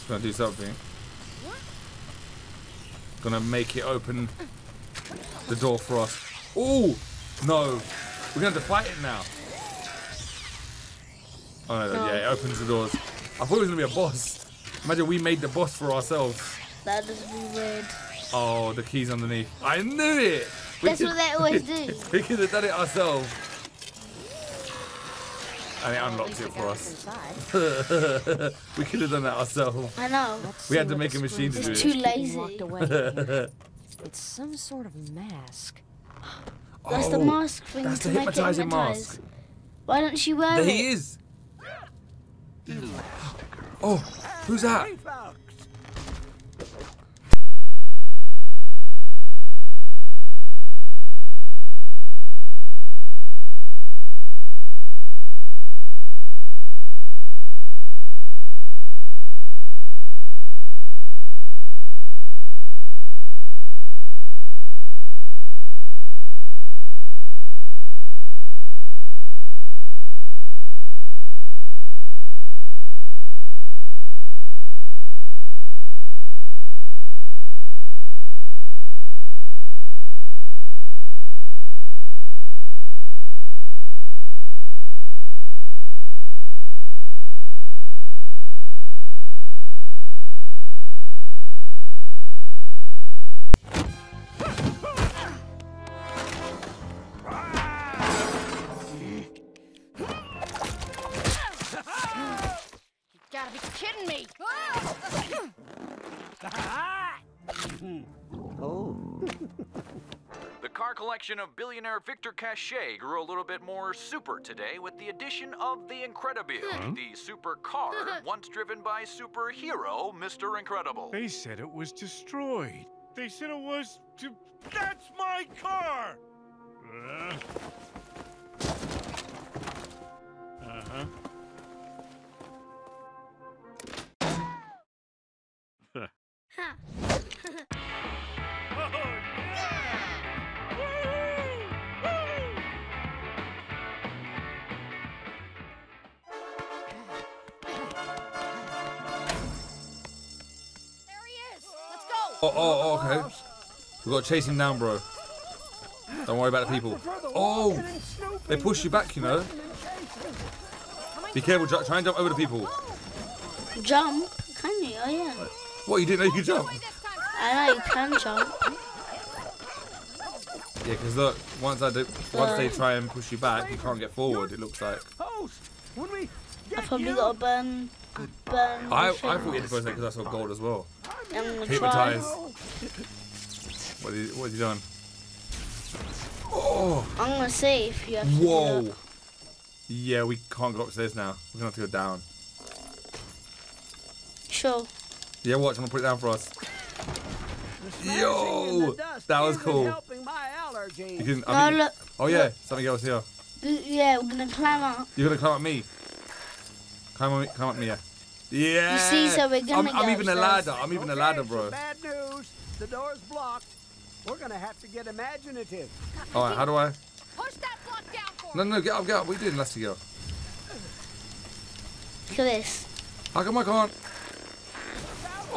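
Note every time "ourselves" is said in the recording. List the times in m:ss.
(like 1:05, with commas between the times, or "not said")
0:15, 0:22, 0:29.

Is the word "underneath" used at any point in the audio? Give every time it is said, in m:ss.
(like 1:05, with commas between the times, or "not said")
0:19.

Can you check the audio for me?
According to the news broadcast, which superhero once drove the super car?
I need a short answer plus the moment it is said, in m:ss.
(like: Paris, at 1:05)
Mr. Incredible, at 2:00.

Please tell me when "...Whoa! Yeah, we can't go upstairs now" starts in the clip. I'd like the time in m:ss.
3:08.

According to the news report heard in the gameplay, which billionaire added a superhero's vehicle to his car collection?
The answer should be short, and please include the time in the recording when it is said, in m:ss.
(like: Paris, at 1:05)
Victor Cachet, at 1:52.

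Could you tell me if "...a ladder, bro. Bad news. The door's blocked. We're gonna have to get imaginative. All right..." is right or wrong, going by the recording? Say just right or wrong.
right.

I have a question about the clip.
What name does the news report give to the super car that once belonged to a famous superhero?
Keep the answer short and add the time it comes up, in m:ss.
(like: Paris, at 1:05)
the Incredibile, at 1:55.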